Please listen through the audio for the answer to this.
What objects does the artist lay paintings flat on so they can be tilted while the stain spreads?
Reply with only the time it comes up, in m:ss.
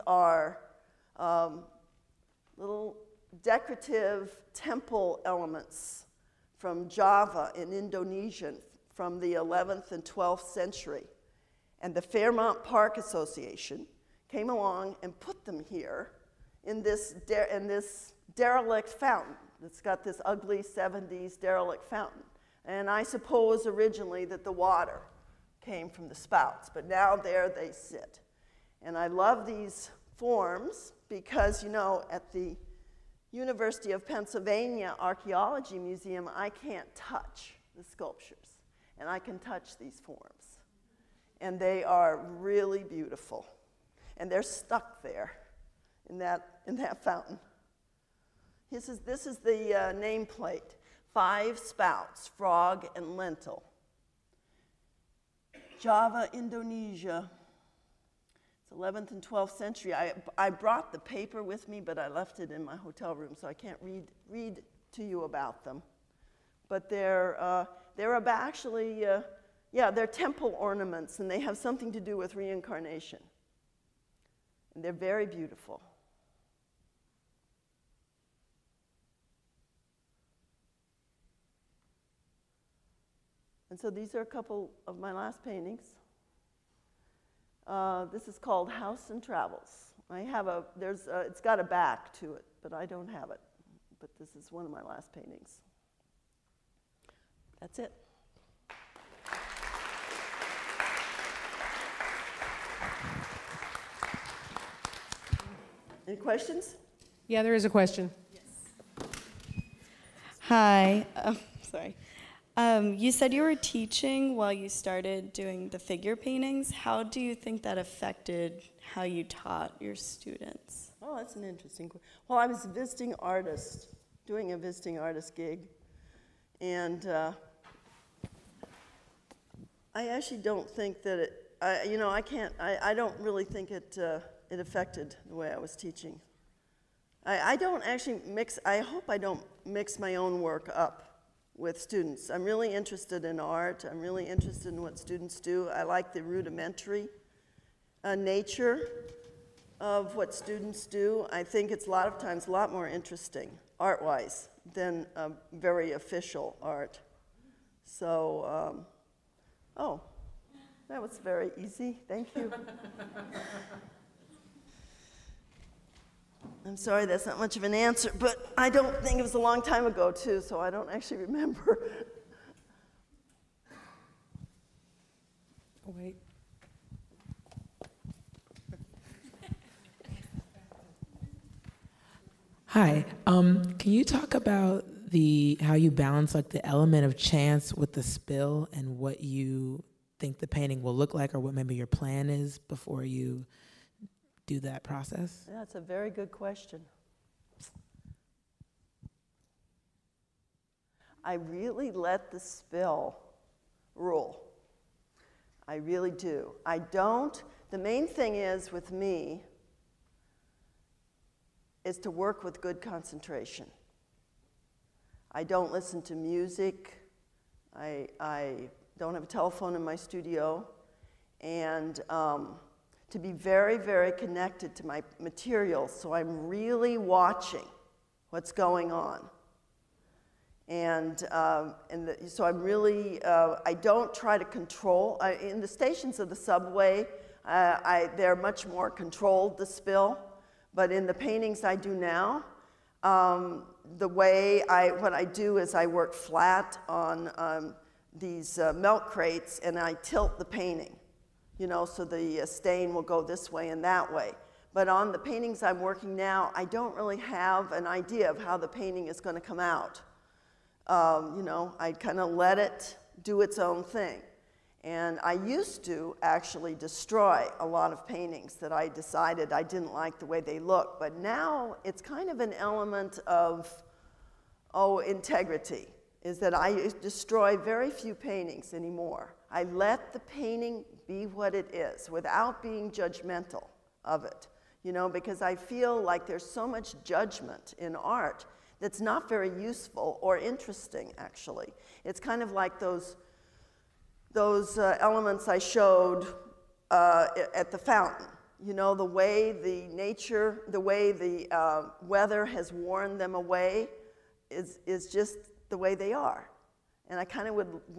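4:08.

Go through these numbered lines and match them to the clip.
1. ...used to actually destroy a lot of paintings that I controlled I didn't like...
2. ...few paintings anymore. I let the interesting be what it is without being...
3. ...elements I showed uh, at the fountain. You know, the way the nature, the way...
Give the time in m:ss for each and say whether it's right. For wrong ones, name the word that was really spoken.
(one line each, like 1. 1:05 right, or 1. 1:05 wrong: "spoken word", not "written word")
1. 4:25 wrong: "decided", not "controlled"
2. 4:37 wrong: "painting", not "interesting"
3. 4:55 right.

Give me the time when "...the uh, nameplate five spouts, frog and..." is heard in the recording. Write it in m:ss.
0:49.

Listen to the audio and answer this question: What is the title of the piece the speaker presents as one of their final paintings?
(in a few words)
House and Travels.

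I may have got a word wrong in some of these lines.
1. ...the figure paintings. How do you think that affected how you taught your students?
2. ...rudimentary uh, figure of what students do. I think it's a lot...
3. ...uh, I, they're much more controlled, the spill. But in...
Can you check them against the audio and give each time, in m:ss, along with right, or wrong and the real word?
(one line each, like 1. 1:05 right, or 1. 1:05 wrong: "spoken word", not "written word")
1. 1:55 right
2. 2:26 wrong: "nature", not "figure"
3. 3:57 right.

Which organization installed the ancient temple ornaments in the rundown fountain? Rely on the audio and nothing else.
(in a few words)
Fairmount Park Association.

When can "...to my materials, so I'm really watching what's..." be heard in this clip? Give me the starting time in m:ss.
3:44.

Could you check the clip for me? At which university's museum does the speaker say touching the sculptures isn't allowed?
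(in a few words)
University of Pennsylvania.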